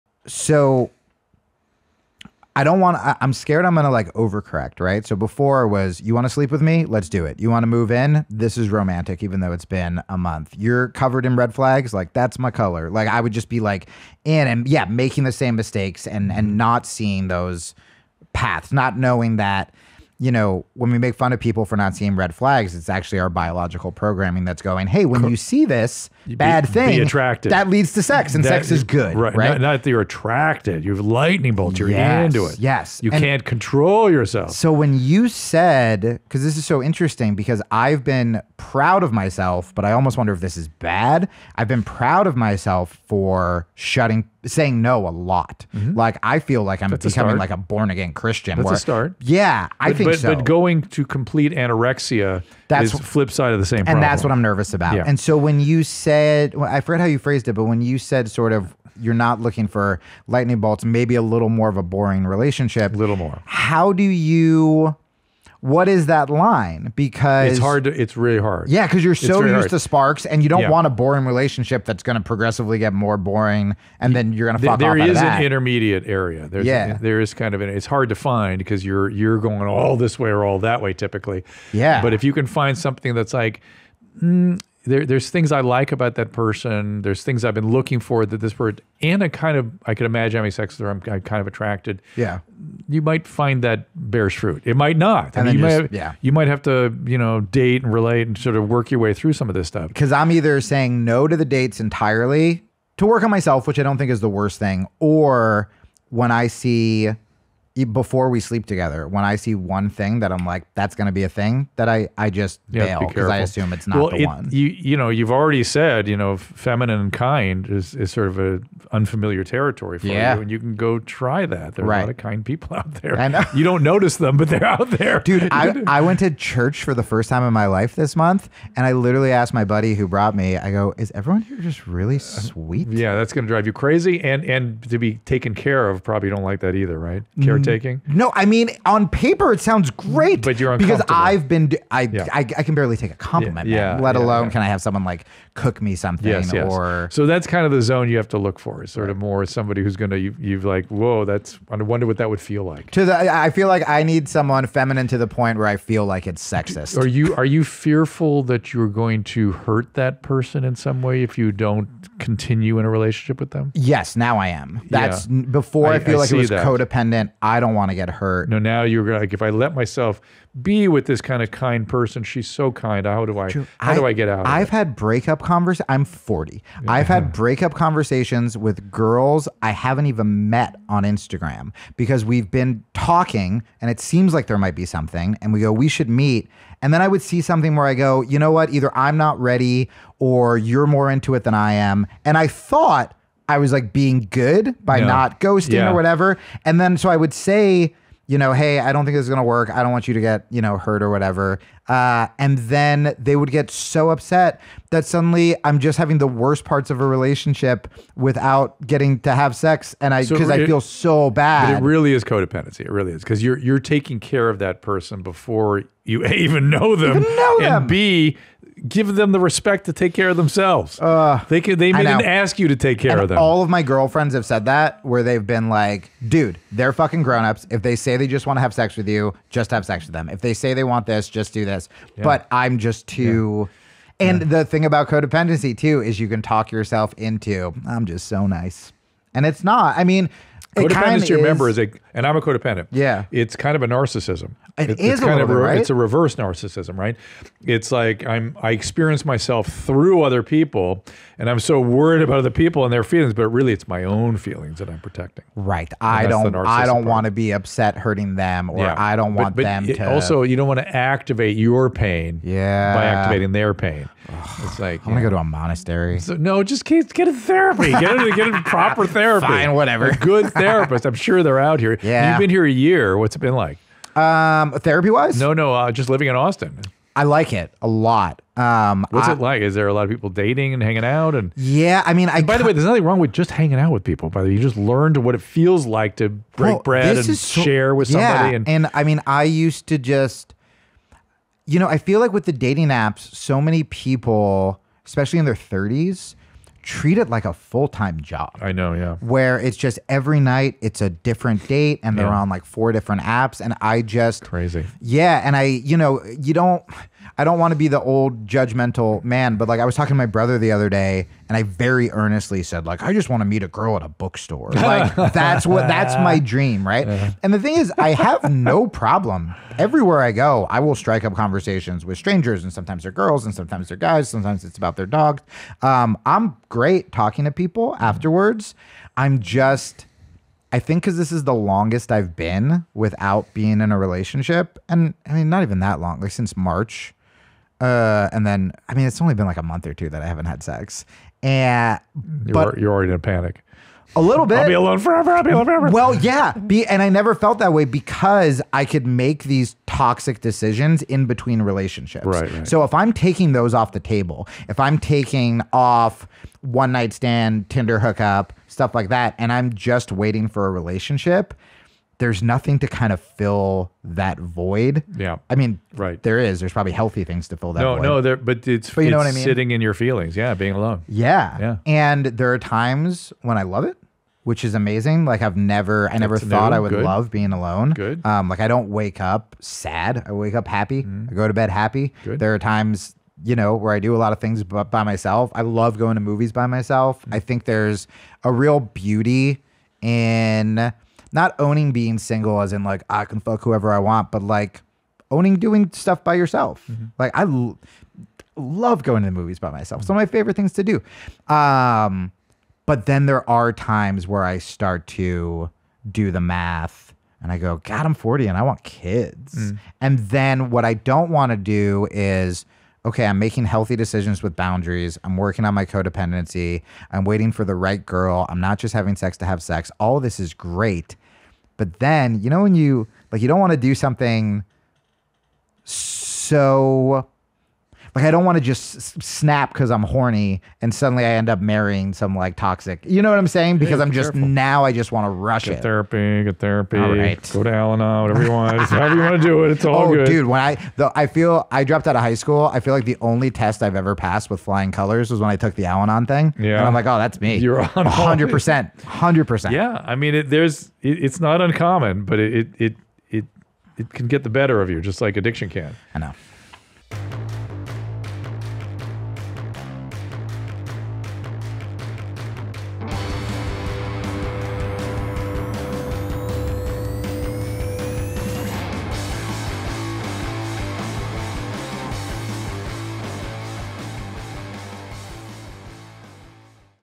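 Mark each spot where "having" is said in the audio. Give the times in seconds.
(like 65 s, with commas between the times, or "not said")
90 s, 205 s, 418 s.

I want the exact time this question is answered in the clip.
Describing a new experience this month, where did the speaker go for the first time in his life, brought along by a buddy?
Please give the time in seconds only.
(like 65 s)
126 s.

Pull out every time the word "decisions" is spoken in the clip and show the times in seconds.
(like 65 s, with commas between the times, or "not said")
350 s, 413 s.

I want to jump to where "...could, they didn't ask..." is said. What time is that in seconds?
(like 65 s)
221 s.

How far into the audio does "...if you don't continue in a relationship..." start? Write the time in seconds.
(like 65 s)
161 s.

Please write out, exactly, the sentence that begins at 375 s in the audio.
Like I've never, I That's never thought new.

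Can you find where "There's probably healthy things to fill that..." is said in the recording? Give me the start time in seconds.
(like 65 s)
366 s.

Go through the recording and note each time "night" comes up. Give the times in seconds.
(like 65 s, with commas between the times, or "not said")
300 s, 356 s.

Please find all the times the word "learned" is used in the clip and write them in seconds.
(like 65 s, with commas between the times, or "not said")
284 s.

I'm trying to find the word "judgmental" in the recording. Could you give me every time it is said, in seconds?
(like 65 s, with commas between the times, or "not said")
308 s.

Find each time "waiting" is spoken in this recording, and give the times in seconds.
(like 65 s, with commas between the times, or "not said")
360 s, 417 s.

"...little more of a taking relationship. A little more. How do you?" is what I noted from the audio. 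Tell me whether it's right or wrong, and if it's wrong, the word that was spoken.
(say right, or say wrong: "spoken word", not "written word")
wrong: "boring", not "taking".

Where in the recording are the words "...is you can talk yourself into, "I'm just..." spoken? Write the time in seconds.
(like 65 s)
236 s.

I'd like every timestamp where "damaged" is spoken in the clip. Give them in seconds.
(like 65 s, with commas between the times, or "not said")
not said.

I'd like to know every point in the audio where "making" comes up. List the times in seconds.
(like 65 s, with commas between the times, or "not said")
14 s, 413 s.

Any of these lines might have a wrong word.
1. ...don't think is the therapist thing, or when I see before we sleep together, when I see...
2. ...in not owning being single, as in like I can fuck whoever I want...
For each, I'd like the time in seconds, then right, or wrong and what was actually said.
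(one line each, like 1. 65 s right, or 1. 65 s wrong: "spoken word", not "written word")
1. 103 s wrong: "worst", not "therapist"
2. 390 s right.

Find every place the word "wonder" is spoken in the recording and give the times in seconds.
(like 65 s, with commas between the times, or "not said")
40 s, 151 s.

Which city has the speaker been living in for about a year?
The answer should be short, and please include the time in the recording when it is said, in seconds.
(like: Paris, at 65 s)
Austin, at 276 s.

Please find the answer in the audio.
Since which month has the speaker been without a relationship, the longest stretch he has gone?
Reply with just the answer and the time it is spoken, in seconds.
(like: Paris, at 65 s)
March, at 336 s.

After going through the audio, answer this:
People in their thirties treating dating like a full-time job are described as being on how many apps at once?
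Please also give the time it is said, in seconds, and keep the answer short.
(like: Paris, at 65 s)
4, at 302 s.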